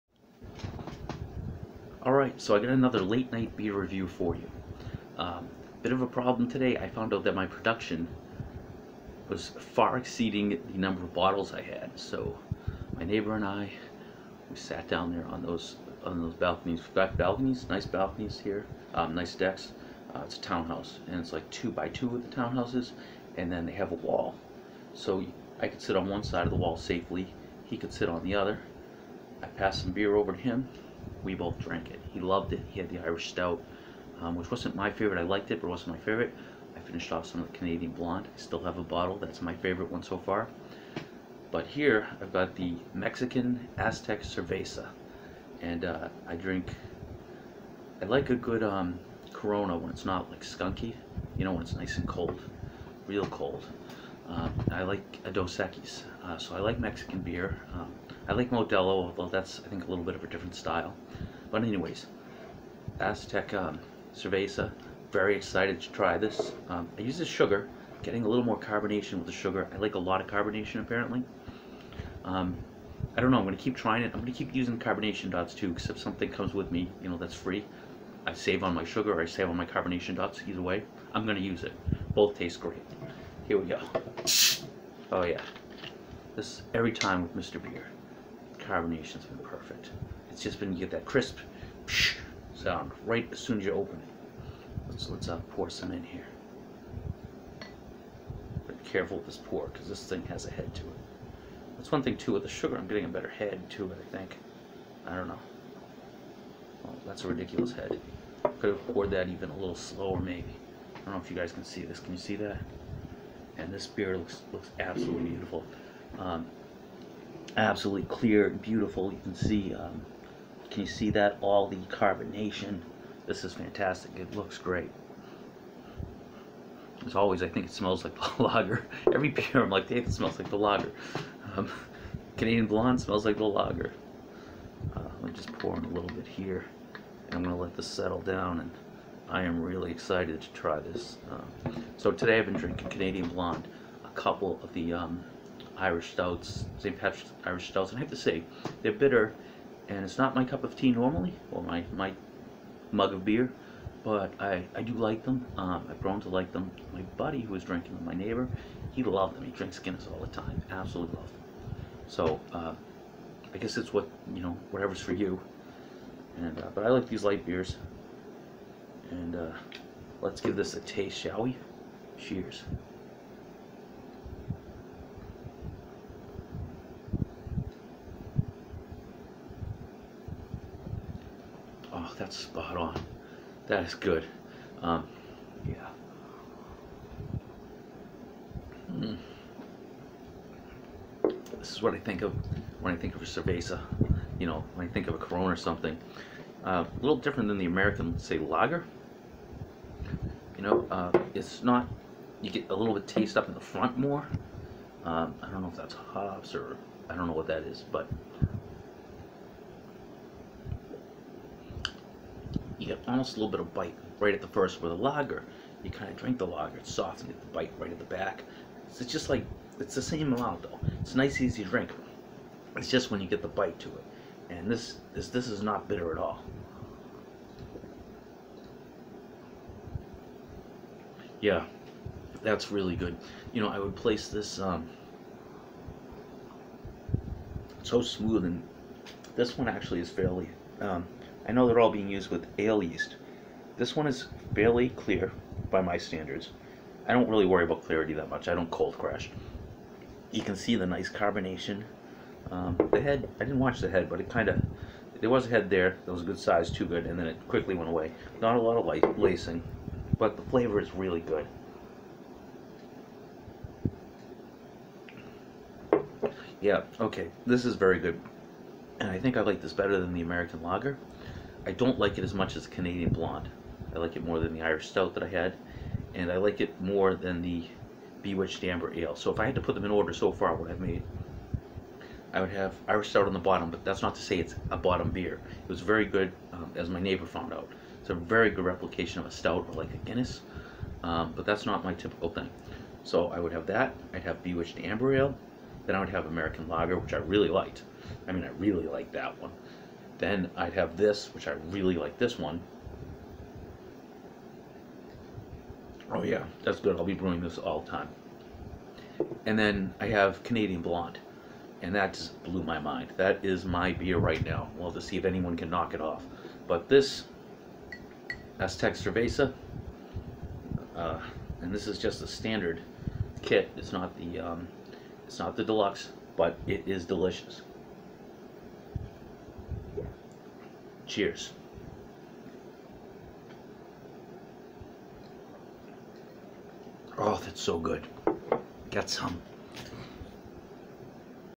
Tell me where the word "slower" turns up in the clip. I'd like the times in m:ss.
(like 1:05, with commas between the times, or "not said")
1:49.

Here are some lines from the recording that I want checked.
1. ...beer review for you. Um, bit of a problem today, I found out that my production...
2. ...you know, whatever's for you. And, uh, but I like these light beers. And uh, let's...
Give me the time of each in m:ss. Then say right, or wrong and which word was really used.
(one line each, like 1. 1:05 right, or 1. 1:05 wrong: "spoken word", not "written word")
1. 0:03 right
2. 2:44 right.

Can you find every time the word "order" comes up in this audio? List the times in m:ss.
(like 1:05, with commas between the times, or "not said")
4:39.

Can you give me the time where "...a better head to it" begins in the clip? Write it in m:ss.
1:43.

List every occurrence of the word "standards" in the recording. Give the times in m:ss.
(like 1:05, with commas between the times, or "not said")
4:05, 5:22.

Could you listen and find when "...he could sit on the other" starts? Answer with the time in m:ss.
0:27.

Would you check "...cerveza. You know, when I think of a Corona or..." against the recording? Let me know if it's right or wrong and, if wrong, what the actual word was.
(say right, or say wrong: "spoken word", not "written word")
right.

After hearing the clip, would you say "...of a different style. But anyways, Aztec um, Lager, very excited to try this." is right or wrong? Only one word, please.
wrong.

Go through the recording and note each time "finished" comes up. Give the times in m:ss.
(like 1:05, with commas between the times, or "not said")
0:36.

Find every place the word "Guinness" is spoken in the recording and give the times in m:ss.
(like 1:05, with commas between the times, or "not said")
2:39, 4:49.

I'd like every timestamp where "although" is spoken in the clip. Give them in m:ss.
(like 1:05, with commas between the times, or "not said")
0:59.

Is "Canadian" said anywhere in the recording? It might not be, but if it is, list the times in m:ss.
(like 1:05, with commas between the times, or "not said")
0:37, 2:12, 2:22, 4:32, 5:10.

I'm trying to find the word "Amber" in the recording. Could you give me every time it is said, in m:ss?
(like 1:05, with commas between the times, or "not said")
4:38, 4:54.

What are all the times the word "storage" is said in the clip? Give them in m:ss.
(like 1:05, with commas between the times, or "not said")
not said.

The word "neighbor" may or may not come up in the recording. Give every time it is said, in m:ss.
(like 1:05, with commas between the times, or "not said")
0:13, 2:38, 4:46.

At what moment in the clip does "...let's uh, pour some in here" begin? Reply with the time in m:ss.
1:35.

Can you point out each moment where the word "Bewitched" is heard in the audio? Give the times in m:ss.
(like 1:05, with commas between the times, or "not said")
4:38, 4:54.